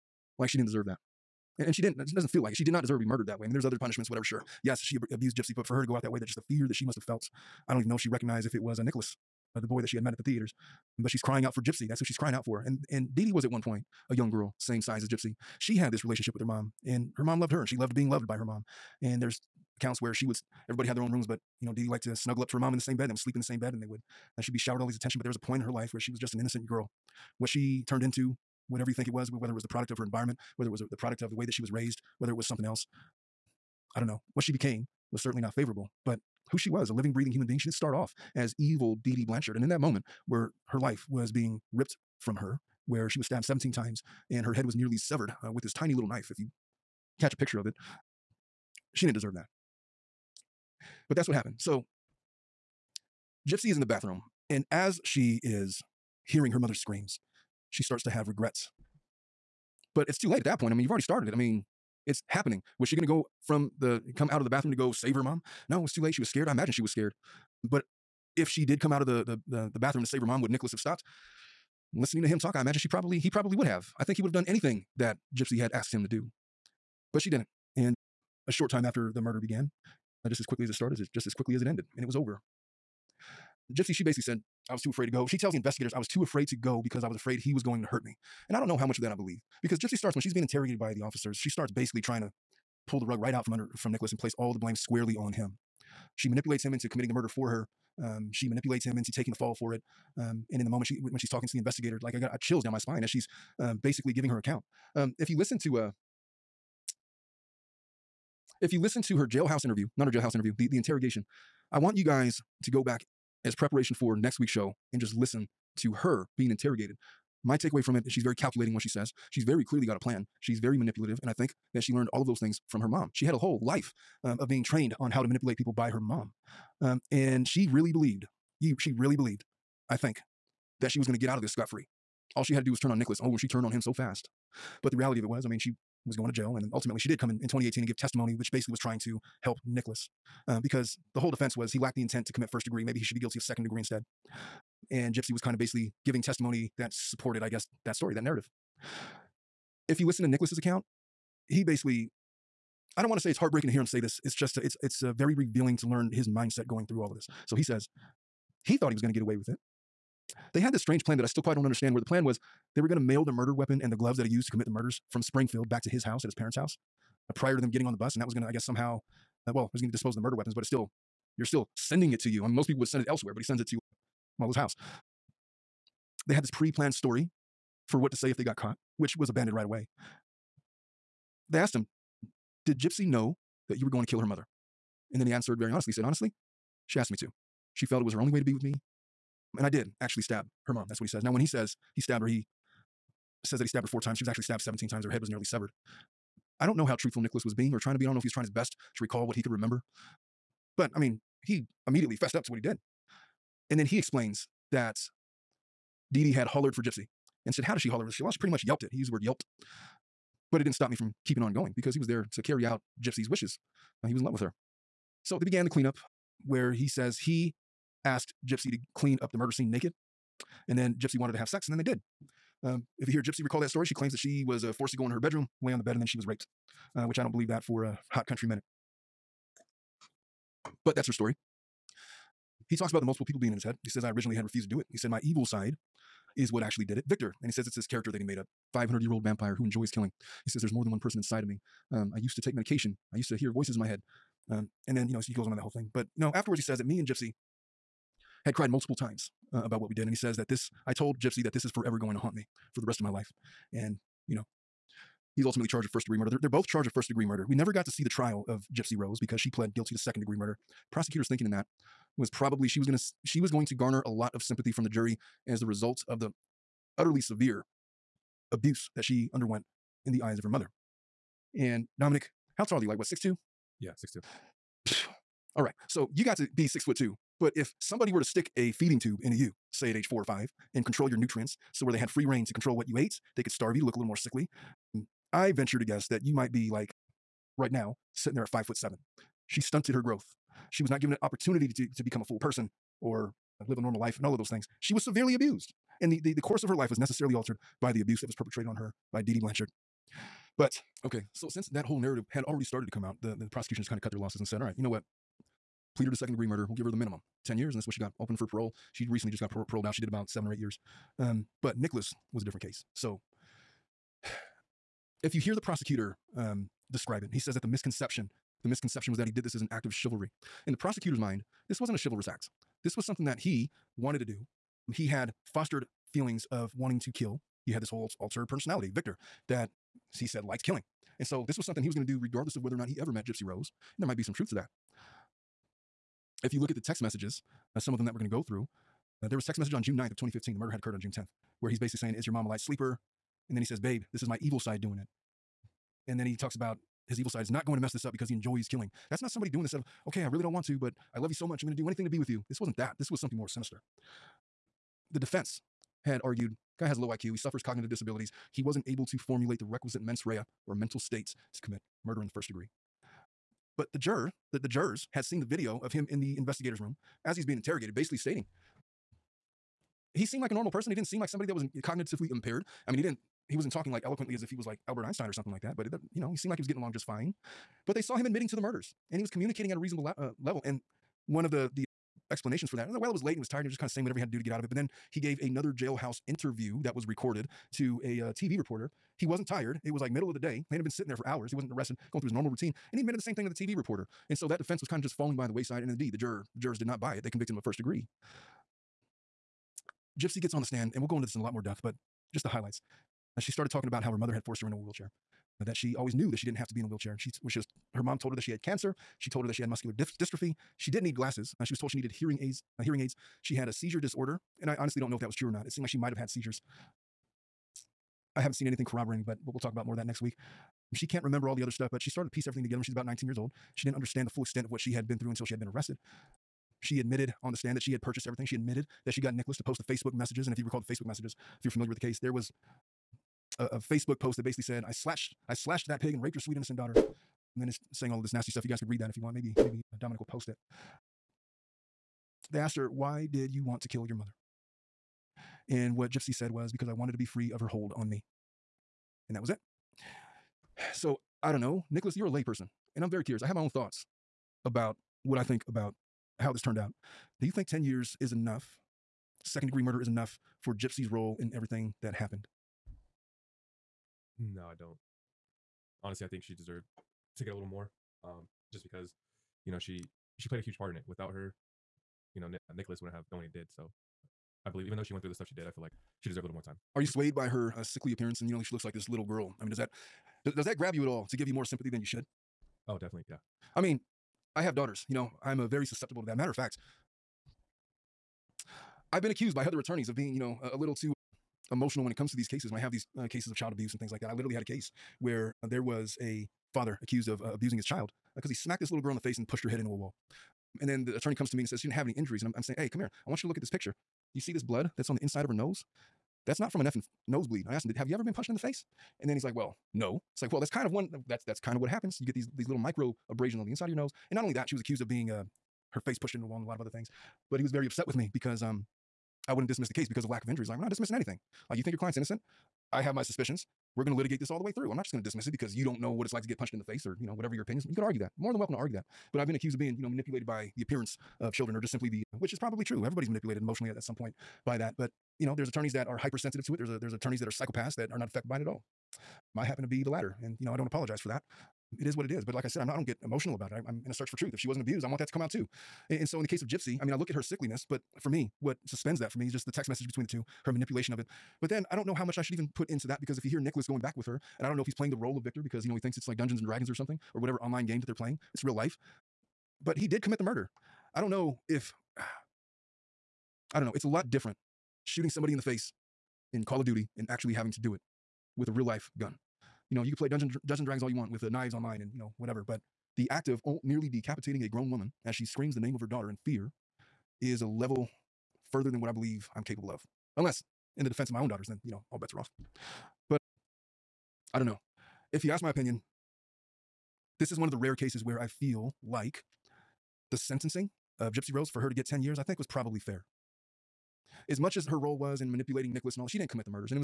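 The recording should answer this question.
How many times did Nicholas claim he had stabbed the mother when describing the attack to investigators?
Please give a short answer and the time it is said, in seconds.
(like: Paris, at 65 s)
4, at 193 s.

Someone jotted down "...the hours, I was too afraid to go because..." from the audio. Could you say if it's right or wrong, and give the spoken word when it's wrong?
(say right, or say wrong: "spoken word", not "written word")
wrong: "investigators", not "hours".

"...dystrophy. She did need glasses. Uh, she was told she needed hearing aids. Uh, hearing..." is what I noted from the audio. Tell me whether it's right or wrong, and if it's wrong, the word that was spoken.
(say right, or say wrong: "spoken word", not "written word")
right.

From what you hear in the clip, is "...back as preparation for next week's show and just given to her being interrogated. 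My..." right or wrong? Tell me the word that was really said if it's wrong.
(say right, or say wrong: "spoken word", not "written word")
wrong: "listen", not "given".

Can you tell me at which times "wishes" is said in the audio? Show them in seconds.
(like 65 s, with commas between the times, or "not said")
213 s.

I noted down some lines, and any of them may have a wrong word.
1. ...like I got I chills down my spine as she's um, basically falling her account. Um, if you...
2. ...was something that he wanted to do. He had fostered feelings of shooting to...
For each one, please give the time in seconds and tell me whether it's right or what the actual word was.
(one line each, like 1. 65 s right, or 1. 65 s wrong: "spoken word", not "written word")
1. 102 s wrong: "giving", not "falling"
2. 322 s wrong: "wanting", not "shooting".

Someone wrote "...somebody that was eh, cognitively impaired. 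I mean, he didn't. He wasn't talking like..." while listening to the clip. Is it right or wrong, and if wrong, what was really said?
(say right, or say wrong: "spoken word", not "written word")
right.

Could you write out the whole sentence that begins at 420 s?
She can't remember all the other stuff, but she started to piece everything together when she's about 19 years old.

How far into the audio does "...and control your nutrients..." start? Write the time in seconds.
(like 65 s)
280 s.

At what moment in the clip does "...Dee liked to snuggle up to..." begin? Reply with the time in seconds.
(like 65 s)
21 s.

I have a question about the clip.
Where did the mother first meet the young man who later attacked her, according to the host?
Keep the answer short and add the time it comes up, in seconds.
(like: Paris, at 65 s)
At the theaters, at 10 s.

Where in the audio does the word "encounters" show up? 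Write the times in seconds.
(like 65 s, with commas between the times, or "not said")
not said.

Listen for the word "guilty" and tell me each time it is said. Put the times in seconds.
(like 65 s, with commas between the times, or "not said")
143 s, 259 s.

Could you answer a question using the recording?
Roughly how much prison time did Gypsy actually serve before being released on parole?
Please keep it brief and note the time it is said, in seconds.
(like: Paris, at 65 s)
7 or 8 years, at 310 s.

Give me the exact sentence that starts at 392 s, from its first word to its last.
And he admitted the same thing to the TV reporter.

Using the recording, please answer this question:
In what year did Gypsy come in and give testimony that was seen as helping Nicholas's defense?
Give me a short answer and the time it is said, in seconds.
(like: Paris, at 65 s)
2018, at 137 s.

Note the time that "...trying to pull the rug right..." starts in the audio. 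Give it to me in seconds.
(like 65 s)
92 s.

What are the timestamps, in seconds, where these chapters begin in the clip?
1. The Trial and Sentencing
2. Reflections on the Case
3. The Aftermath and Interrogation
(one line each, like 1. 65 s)
1. 256 s
2. 450 s
3. 50 s.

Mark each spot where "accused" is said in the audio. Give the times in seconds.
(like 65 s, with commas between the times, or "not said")
489 s, 497 s, 514 s, 529 s.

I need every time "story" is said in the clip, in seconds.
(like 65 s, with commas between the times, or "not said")
147 s, 176 s, 223 s, 231 s.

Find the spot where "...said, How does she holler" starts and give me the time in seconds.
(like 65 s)
207 s.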